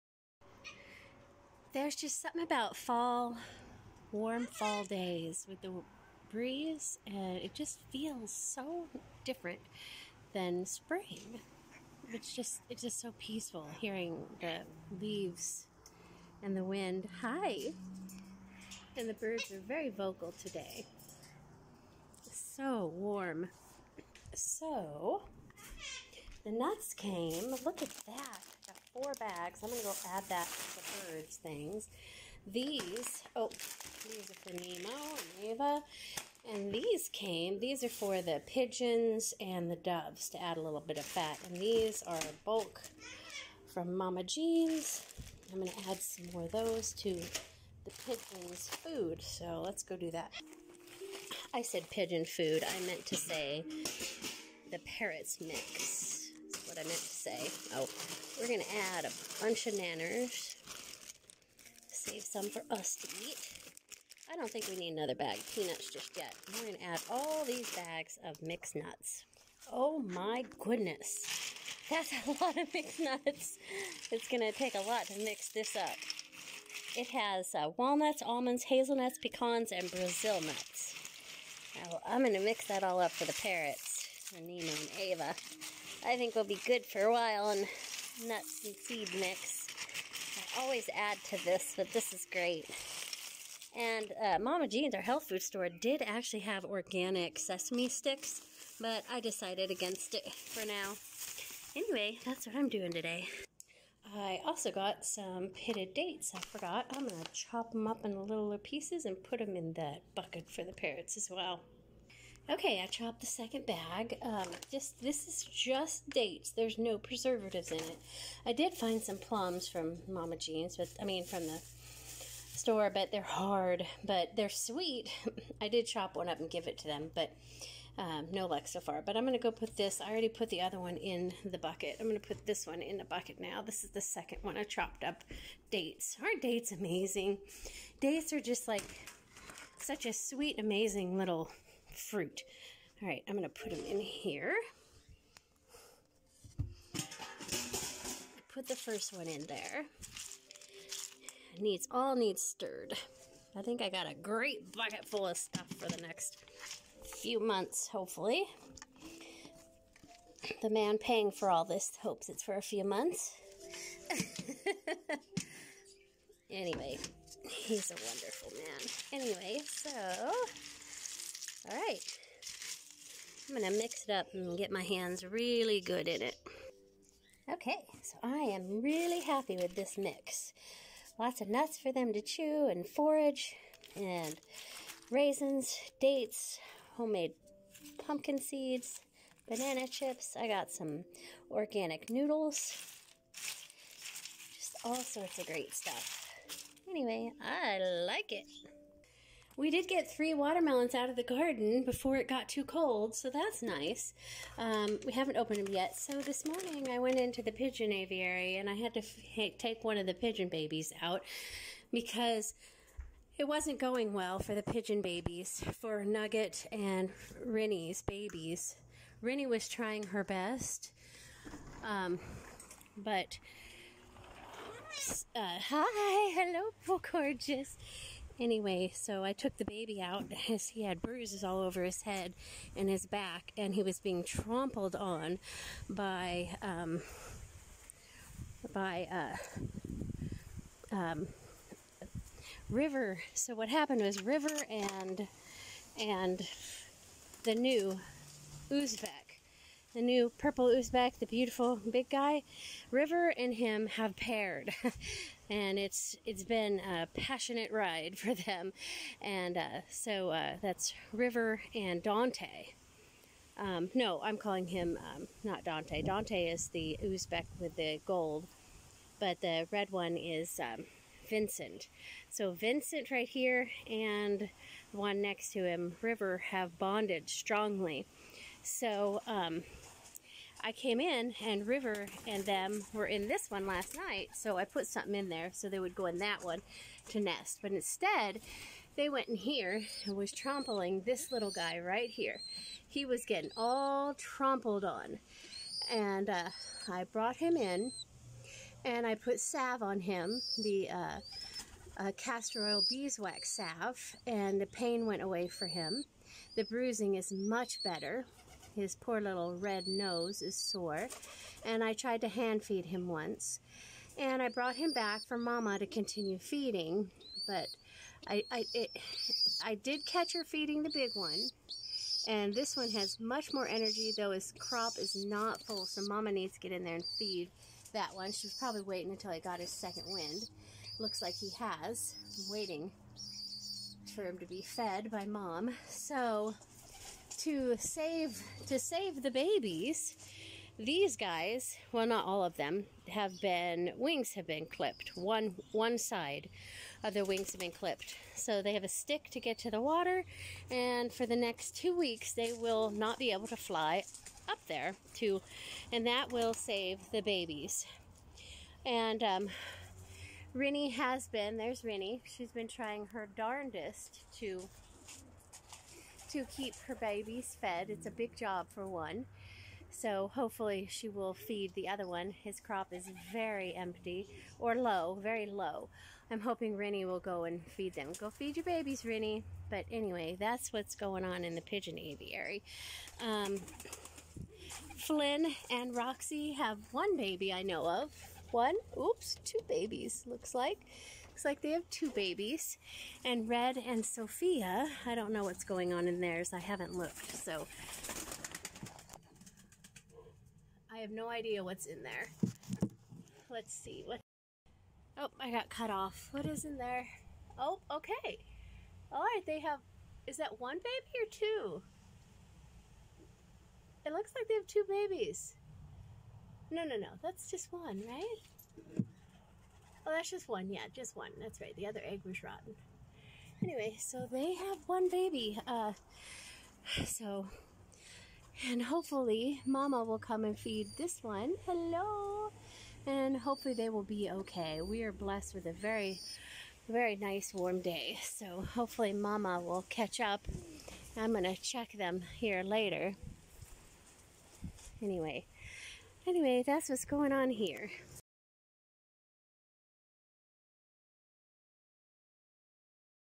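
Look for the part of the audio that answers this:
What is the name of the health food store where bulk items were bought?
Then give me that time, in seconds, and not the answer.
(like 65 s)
43 s.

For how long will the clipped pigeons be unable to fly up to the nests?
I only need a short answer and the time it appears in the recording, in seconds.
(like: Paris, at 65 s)
2 weeks, at 351 s.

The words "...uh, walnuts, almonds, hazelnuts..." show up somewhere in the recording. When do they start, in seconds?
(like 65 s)
77 s.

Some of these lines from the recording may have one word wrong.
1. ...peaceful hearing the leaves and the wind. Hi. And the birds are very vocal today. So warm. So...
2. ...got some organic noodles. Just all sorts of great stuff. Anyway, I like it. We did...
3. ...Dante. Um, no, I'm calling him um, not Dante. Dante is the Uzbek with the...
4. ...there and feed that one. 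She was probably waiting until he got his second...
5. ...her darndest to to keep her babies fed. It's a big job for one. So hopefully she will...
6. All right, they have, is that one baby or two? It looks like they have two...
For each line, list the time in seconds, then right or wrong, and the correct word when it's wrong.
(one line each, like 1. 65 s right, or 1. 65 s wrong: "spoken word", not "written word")
1. 13 s right
2. 190 s right
3. 262 s right
4. 326 s right
5. 363 s right
6. 409 s right.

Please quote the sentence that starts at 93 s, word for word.
And uh, Mama Jean's, our health food store, did actually have organic sesame sticks, but I decided against it for now.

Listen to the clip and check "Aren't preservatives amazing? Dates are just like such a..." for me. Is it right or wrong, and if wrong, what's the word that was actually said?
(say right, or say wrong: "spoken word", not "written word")
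wrong: "dates", not "preservatives".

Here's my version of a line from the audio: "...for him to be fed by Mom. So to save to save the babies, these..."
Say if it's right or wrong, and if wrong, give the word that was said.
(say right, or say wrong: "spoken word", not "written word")
right.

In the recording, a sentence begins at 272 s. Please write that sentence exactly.
So Vincent right here and the one next to him, River, have bonded strongly.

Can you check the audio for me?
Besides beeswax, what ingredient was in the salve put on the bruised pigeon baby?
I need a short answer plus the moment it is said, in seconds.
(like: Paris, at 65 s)
Castor oil, at 302 s.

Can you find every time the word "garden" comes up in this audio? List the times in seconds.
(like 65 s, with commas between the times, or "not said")
201 s.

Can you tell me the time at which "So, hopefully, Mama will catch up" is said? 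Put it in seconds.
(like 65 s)
438 s.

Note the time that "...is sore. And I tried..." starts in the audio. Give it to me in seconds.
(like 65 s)
310 s.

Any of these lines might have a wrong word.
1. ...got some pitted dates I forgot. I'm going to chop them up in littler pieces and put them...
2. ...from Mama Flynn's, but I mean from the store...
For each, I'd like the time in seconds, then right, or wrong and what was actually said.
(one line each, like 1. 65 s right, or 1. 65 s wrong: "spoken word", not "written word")
1. 104 s right
2. 119 s wrong: "Jean", not "Flynn".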